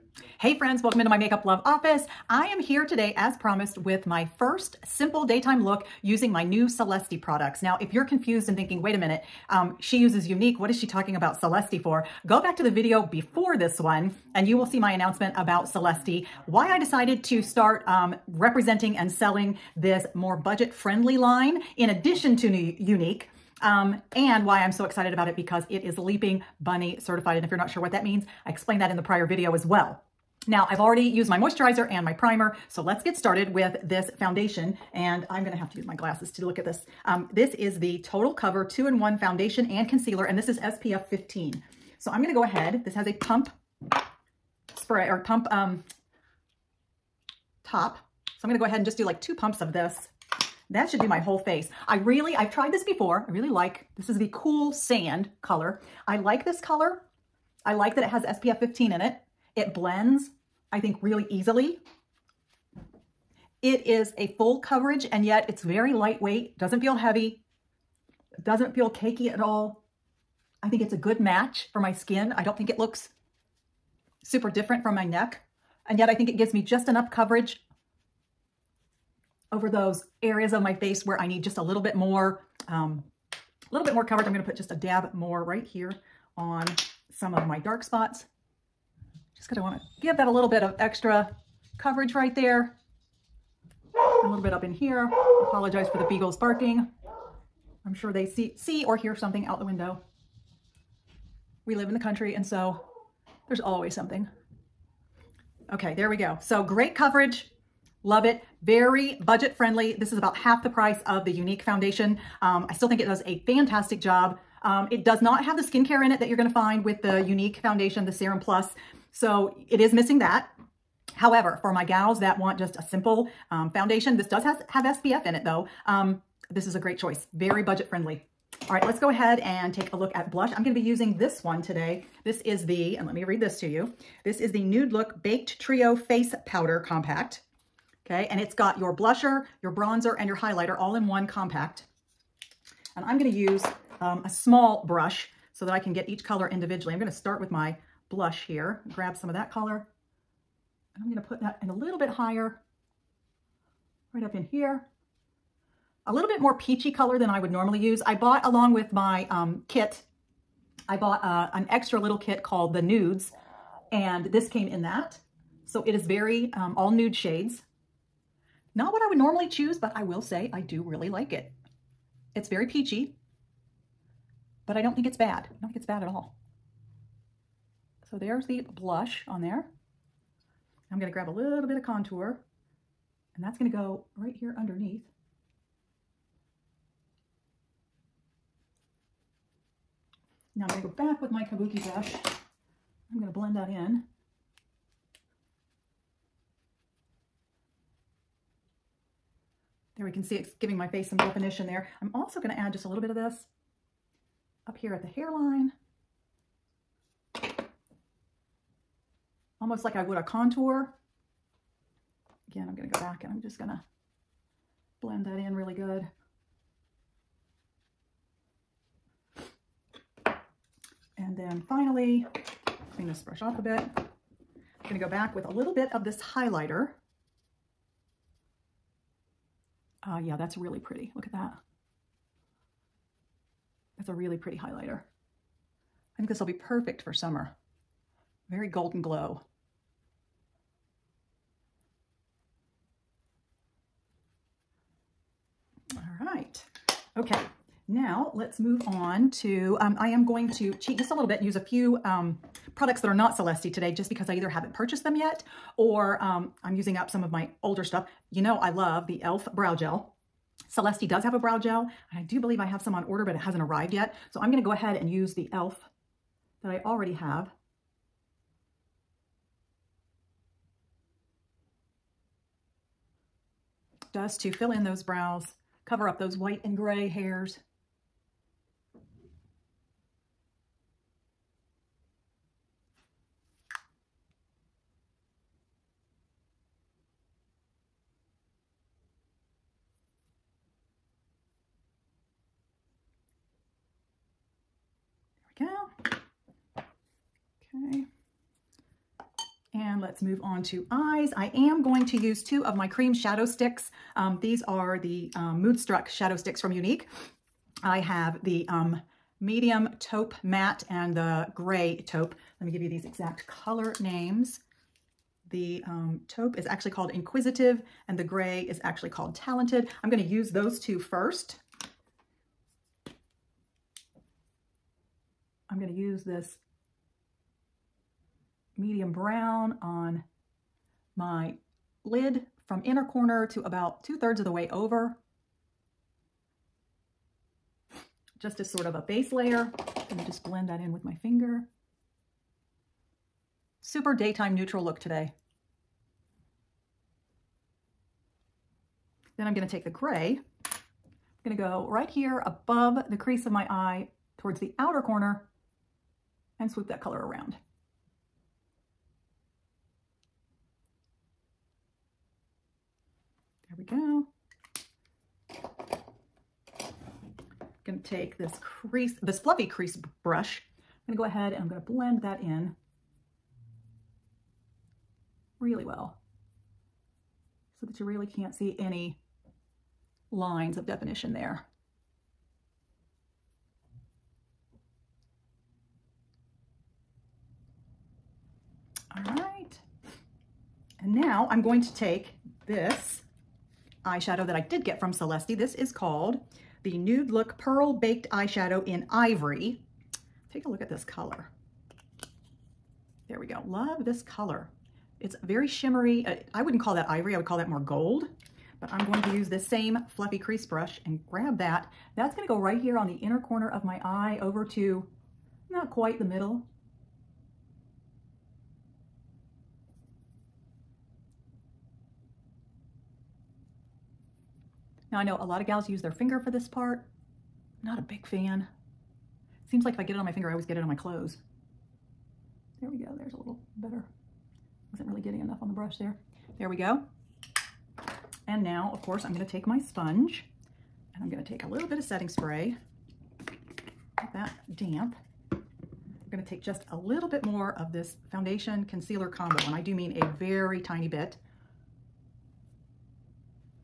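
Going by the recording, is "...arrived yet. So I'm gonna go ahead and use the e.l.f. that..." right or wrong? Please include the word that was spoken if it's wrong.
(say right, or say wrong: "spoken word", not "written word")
right.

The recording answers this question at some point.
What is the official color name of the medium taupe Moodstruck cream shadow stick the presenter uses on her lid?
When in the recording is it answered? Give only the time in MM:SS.
05:17.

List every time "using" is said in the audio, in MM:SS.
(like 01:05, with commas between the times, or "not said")
00:06, 02:10, 04:16.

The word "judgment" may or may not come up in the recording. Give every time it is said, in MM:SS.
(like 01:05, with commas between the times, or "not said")
not said.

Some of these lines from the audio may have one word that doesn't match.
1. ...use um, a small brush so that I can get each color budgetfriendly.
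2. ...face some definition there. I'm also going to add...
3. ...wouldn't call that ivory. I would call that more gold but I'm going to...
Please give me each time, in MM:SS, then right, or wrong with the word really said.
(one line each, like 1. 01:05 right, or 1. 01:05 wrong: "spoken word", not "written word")
1. 02:23 wrong: "individually", not "budgetfriendly"
2. 03:20 right
3. 06:46 right.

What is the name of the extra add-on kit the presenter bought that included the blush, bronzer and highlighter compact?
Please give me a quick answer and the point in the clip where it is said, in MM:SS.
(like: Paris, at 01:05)
the Nudes, at 02:42.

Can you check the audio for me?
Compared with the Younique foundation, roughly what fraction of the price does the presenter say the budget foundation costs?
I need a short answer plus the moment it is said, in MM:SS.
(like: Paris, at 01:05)
half, at 01:50.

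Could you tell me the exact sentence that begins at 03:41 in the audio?
And then finally, clean this brush off a bit.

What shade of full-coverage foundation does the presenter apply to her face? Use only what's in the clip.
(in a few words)
cool sand.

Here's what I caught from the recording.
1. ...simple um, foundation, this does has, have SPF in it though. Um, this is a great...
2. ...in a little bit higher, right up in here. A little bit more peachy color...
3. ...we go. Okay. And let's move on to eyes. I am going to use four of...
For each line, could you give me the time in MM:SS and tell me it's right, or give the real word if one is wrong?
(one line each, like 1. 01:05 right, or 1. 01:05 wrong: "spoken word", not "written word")
1. 02:02 right
2. 02:31 right
3. 04:55 wrong: "two", not "four".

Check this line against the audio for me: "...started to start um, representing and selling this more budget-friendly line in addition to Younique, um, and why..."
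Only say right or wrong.
wrong.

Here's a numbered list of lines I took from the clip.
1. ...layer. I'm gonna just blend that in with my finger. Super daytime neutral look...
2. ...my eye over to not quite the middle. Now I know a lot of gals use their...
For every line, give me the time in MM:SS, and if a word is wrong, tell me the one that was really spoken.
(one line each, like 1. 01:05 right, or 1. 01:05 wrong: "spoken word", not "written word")
1. 05:39 right
2. 06:53 right.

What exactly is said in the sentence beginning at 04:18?
You know, I love the e.l.f.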